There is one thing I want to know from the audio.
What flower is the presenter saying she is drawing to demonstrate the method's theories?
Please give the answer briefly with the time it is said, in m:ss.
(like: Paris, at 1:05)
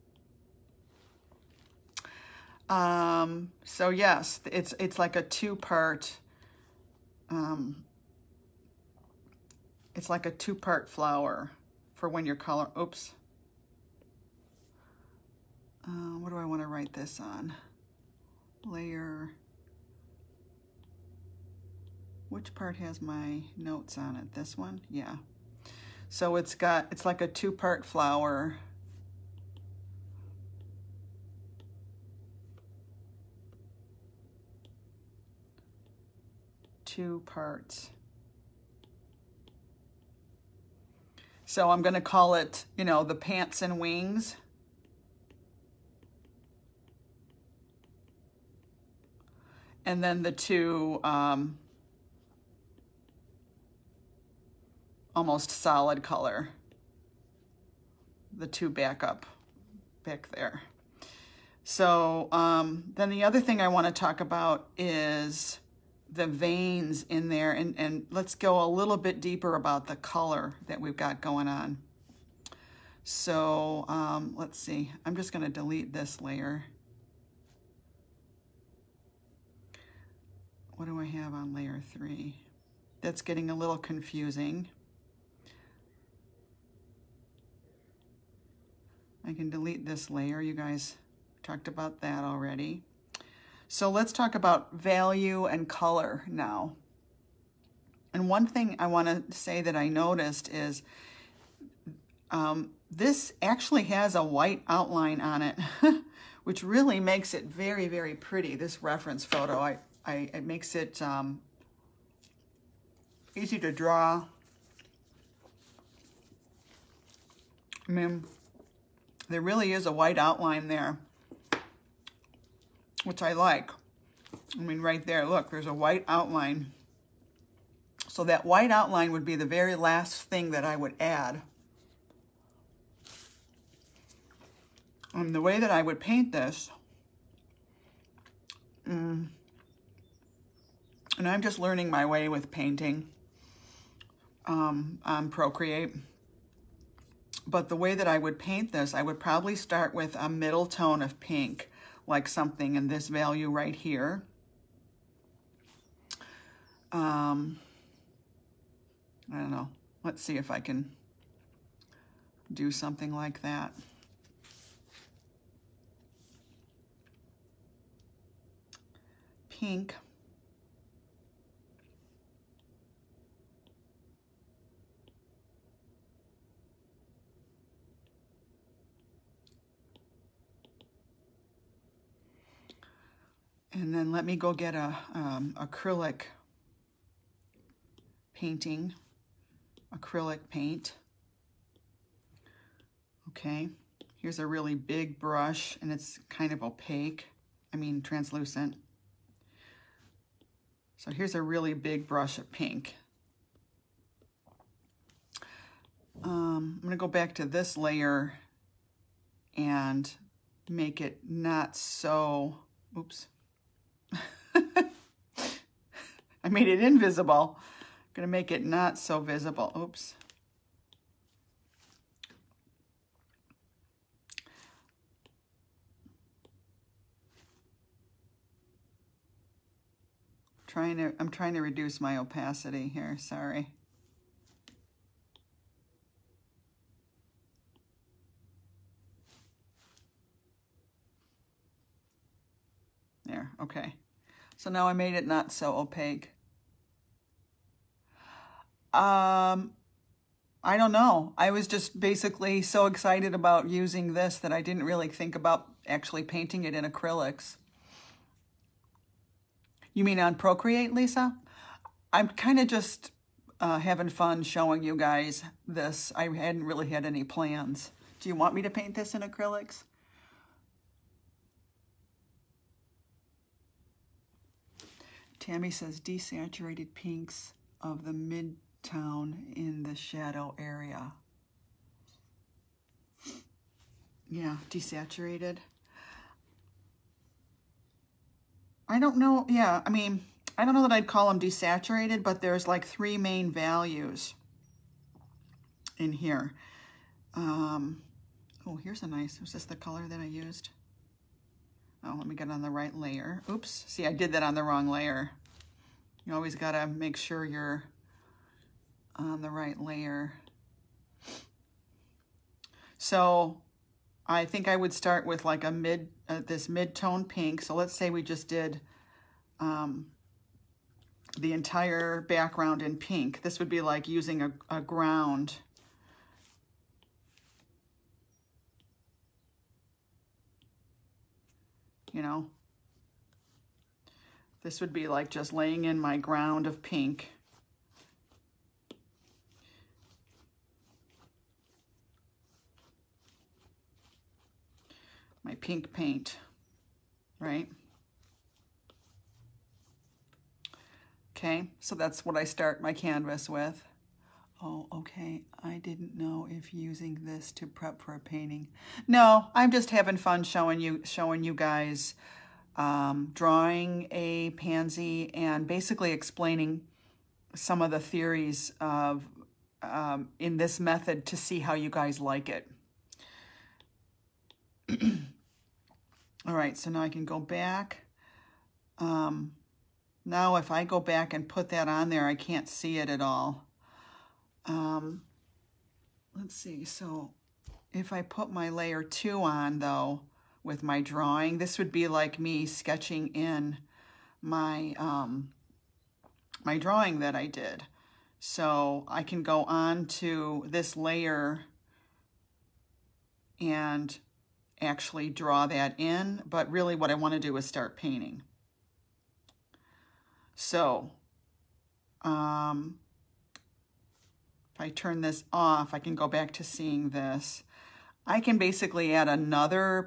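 pansy, at 6:04.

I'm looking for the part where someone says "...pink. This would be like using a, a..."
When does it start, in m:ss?
5:22.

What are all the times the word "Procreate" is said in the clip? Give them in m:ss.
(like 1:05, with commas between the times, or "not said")
2:25, 4:20.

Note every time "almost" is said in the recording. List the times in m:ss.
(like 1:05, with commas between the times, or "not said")
0:55.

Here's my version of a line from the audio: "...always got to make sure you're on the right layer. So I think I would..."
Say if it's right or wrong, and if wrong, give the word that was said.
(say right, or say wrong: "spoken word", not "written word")
right.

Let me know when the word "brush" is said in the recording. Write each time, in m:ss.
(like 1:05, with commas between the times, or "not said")
3:15, 3:22.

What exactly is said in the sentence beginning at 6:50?
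So um, if I turn this off, I can go back to seeing this.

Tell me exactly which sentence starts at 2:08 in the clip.
So that white outline would be the very last thing that I would add.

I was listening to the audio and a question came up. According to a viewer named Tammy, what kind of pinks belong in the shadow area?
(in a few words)
desaturated pinks.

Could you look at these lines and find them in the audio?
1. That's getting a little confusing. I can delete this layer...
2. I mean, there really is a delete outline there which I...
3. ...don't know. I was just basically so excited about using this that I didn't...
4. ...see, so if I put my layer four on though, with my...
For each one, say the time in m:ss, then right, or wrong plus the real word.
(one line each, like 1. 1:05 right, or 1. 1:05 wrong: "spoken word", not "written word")
1. 1:23 right
2. 1:57 wrong: "white", not "delete"
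3. 4:10 right
4. 6:26 wrong: "two", not "four".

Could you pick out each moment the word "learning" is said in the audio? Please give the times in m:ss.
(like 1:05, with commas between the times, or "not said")
2:21.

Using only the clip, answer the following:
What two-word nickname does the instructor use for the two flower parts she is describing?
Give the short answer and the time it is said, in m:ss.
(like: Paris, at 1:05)
pants and wings, at 0:43.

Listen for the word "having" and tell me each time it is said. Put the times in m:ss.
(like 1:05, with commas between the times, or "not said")
4:23, 5:59.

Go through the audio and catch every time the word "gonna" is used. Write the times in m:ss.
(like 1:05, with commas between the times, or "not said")
1:15, 3:26.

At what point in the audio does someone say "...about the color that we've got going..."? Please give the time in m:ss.
1:09.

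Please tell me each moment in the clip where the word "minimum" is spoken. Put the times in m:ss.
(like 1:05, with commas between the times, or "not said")
not said.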